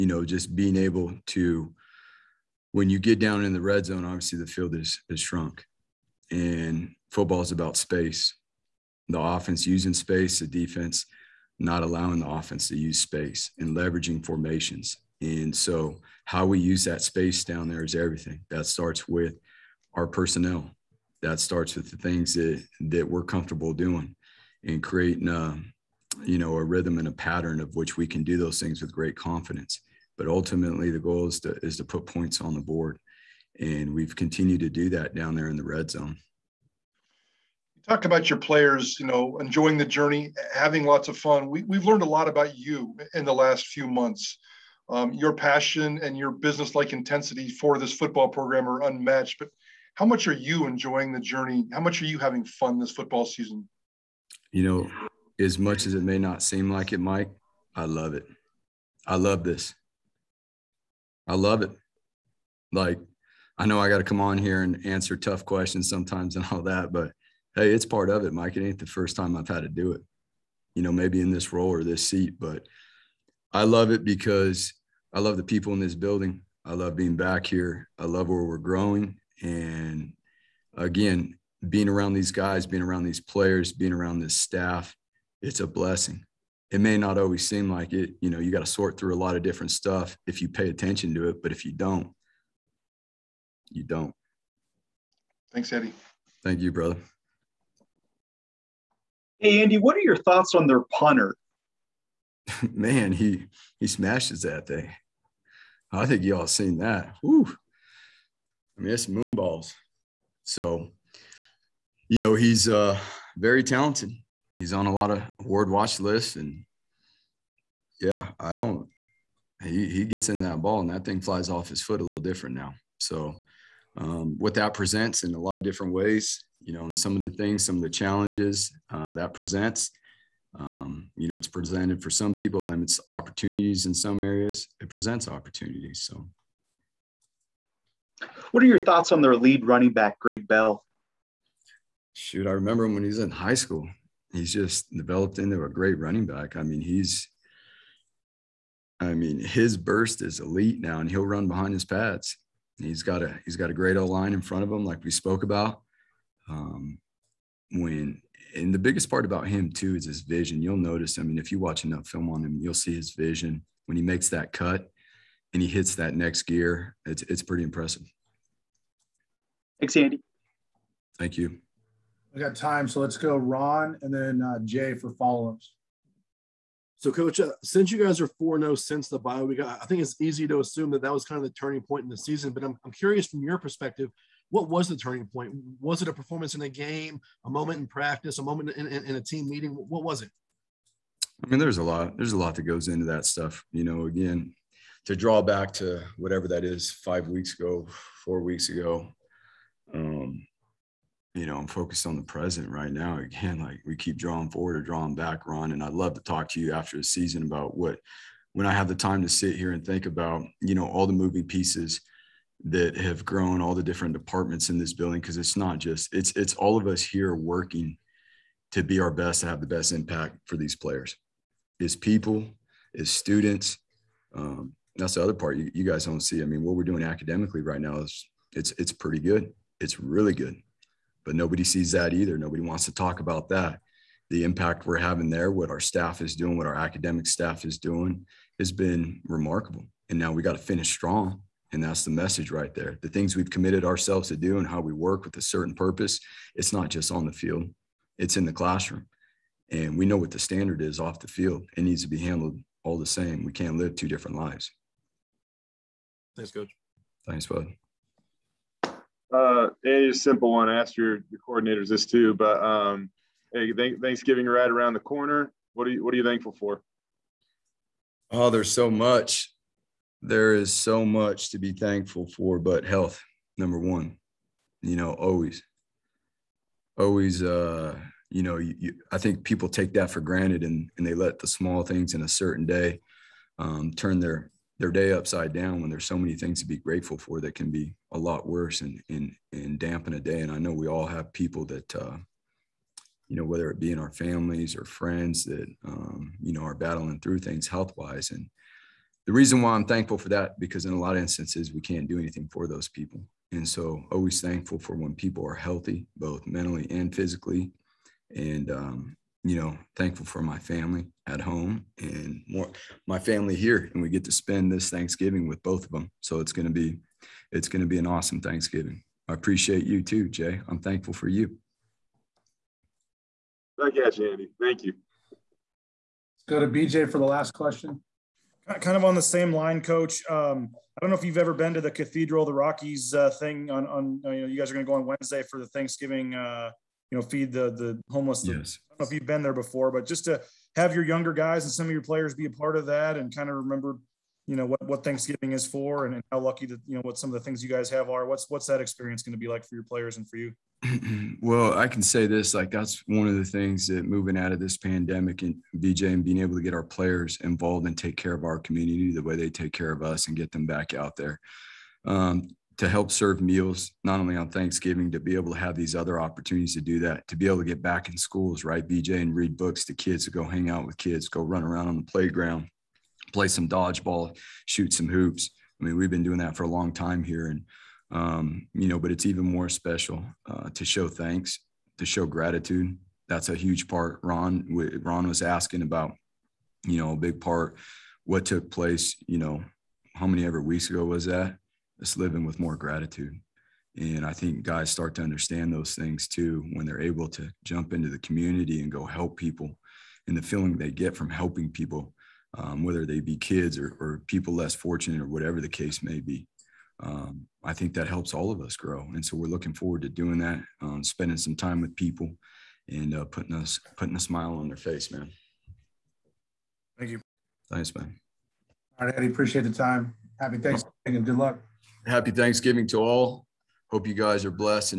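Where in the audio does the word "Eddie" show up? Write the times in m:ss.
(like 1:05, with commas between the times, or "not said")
1:35, 6:59.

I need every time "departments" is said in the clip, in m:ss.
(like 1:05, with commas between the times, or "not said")
3:34.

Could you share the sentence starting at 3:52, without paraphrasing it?
Nobody wants to talk about that.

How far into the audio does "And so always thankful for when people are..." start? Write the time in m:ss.
5:03.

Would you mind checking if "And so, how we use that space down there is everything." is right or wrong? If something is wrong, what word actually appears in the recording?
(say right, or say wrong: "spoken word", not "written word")
right.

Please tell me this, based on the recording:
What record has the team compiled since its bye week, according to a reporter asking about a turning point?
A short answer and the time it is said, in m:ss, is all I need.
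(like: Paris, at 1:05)
4-0, at 2:58.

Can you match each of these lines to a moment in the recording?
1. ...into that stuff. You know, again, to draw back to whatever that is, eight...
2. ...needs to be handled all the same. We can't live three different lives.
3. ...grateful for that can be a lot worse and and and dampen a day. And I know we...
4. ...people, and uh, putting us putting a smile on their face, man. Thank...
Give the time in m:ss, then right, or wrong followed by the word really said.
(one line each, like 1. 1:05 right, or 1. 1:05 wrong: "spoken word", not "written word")
1. 3:12 wrong: "five", not "eight"
2. 4:11 wrong: "two", not "three"
3. 4:46 right
4. 6:51 right.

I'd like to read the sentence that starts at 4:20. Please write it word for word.
I asked your, your coordinators this too, but um, hey, th- Thanksgiving right around the corner.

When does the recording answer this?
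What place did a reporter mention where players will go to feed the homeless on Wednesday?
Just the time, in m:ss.
5:31.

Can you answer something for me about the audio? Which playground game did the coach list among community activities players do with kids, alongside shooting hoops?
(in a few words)
Dodgeball.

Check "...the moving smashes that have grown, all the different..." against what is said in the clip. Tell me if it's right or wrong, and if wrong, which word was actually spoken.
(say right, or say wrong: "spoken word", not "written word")
wrong: "pieces", not "smashes".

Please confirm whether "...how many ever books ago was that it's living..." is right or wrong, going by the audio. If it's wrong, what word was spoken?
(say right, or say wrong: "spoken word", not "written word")
wrong: "weeks", not "books".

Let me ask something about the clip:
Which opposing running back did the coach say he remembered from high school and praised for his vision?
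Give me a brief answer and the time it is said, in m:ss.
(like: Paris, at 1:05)
Greg Bell, at 2:20.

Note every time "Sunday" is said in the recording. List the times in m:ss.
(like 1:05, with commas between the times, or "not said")
not said.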